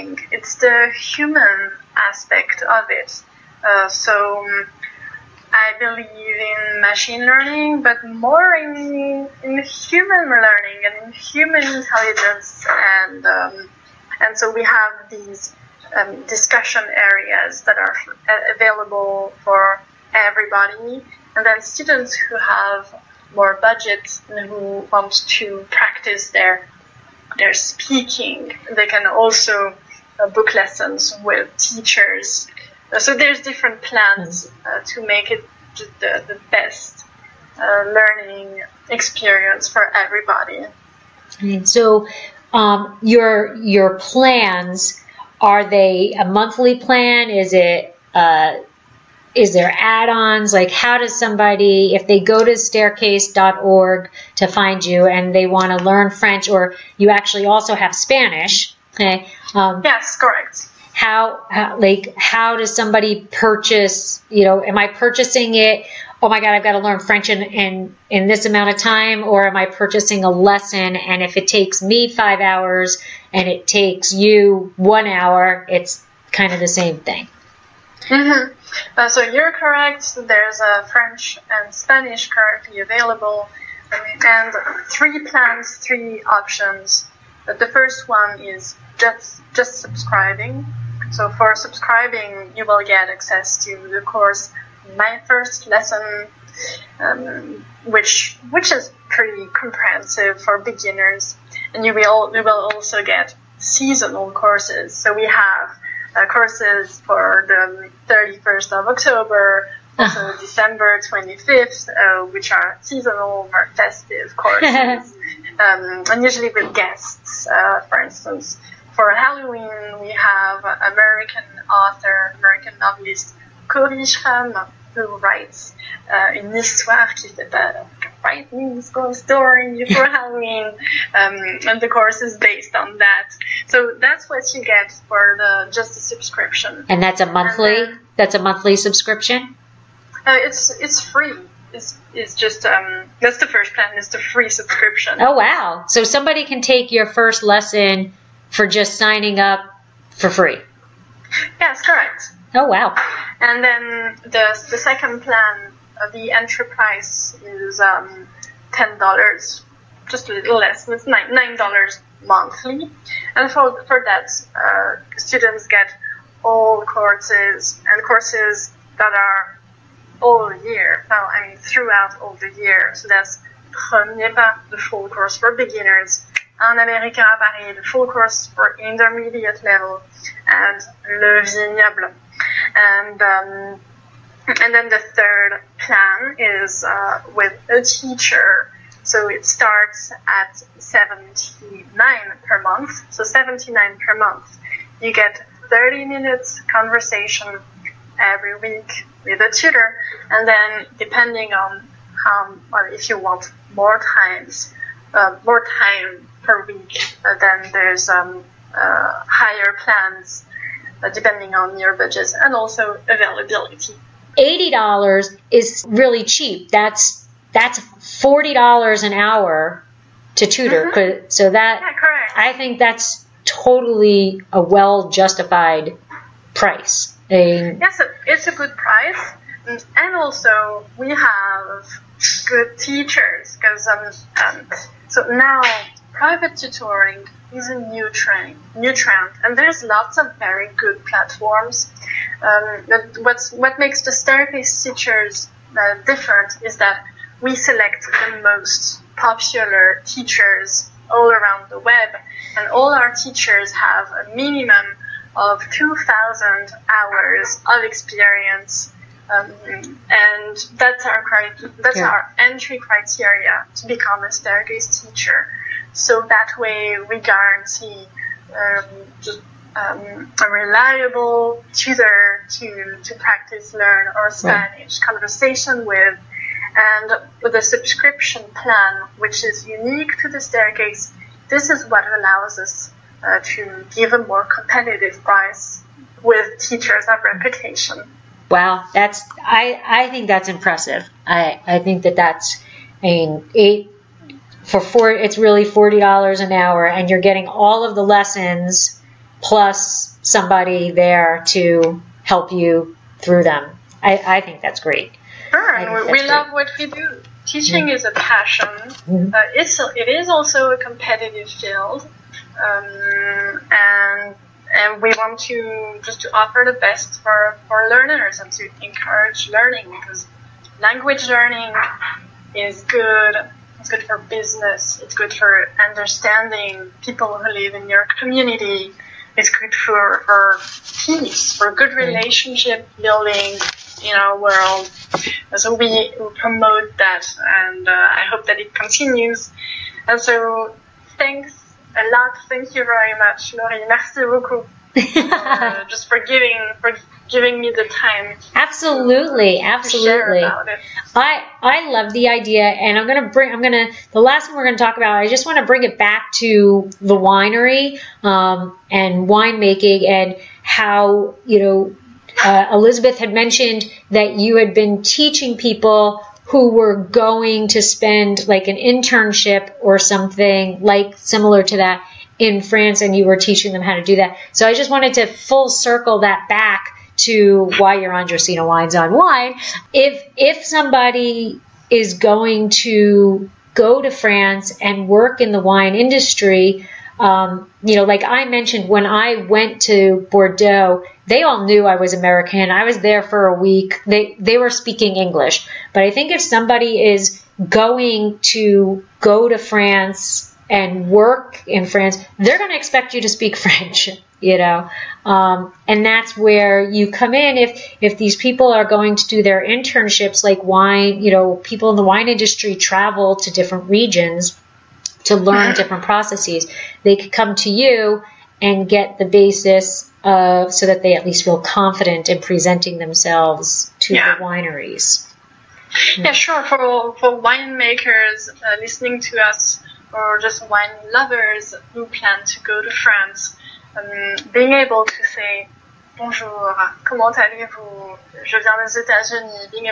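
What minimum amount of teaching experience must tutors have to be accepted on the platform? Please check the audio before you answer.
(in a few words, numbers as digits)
2,000 hours.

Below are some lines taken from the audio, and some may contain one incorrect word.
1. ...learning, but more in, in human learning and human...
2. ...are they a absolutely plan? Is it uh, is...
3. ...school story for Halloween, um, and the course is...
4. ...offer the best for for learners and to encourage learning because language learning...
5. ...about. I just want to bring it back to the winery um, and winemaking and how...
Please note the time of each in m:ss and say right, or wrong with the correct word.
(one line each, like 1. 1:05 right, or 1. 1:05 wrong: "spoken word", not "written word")
1. 0:07 right
2. 0:45 wrong: "monthly", not "absolutely"
3. 2:08 right
4. 5:16 right
5. 5:54 right.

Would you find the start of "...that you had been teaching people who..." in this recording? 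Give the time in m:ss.
6:04.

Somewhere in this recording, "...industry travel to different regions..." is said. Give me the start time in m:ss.
6:52.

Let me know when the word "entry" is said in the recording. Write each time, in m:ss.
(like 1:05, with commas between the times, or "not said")
2:36, 4:22.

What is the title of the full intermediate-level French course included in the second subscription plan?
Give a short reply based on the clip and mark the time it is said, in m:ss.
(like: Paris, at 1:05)
Un Américain à Paris, at 2:56.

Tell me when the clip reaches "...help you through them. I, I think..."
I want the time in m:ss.
5:02.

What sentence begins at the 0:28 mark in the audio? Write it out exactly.
They can also uh, book lessons with teachers.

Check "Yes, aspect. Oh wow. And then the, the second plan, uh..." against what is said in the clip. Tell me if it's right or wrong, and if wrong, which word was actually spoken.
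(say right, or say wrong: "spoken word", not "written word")
wrong: "correct", not "aspect".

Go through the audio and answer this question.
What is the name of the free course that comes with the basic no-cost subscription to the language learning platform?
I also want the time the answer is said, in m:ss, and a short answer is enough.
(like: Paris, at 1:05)
My First Lesson, at 1:34.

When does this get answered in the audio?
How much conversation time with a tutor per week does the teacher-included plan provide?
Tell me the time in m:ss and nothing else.
3:15.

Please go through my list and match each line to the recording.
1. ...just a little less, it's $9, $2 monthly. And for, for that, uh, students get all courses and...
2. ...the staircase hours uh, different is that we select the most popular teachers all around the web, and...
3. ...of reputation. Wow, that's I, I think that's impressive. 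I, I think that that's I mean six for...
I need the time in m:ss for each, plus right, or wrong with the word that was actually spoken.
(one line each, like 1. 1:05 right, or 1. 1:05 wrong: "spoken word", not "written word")
1. 2:40 wrong: "9", not "2"
2. 4:04 wrong: "teachers", not "hours"
3. 4:47 wrong: "eight", not "six".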